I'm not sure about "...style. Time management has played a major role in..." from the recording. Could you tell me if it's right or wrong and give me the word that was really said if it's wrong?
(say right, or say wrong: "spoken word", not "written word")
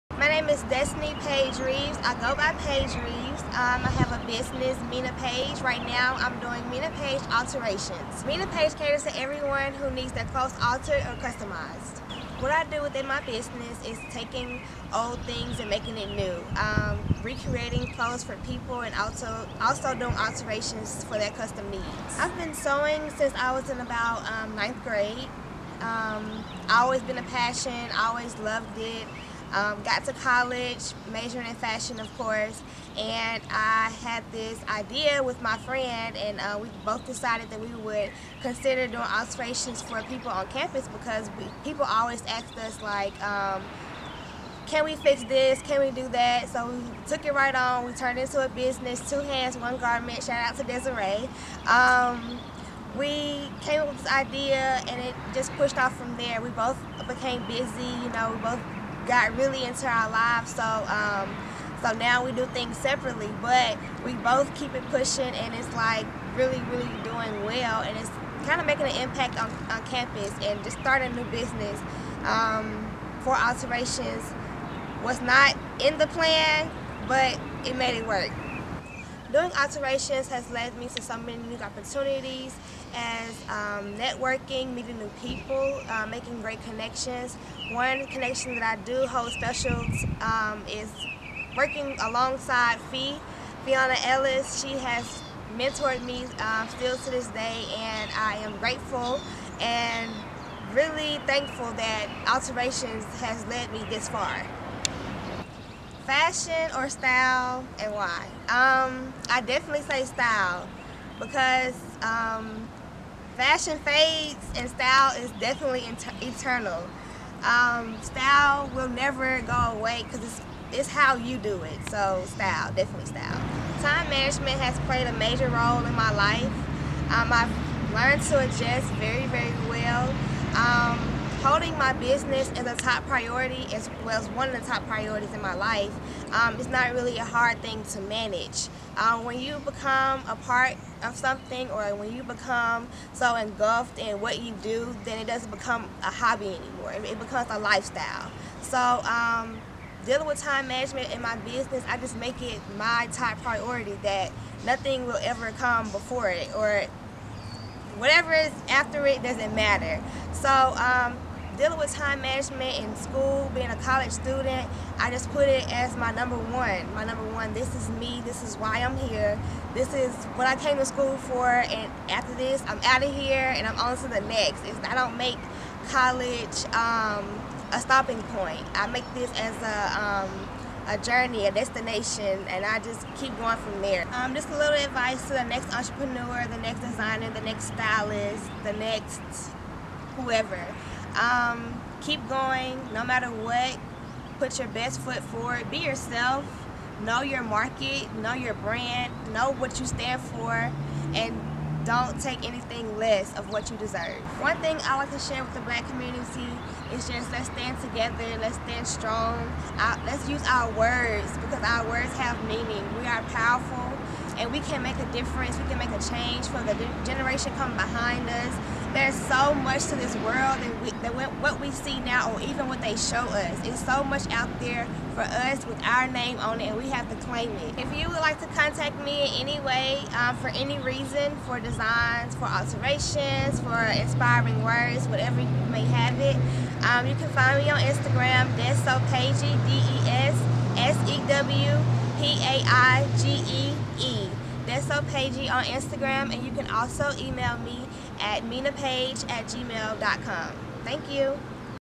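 right.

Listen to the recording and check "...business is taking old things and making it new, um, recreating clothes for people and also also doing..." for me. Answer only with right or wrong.
right.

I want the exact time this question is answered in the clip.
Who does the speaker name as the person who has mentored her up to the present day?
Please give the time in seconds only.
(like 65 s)
93 s.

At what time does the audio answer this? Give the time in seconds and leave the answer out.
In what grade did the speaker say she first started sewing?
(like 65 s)
24 s.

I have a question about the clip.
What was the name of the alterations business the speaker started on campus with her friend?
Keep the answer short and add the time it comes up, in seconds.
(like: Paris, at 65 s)
Two Hands, One Garment, at 49 s.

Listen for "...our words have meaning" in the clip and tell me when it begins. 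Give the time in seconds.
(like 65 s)
211 s.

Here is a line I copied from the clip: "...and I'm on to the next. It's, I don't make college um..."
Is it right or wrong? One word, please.
right.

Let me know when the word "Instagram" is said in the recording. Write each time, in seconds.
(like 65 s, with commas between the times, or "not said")
237 s, 245 s.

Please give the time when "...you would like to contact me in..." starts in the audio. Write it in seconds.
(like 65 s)
227 s.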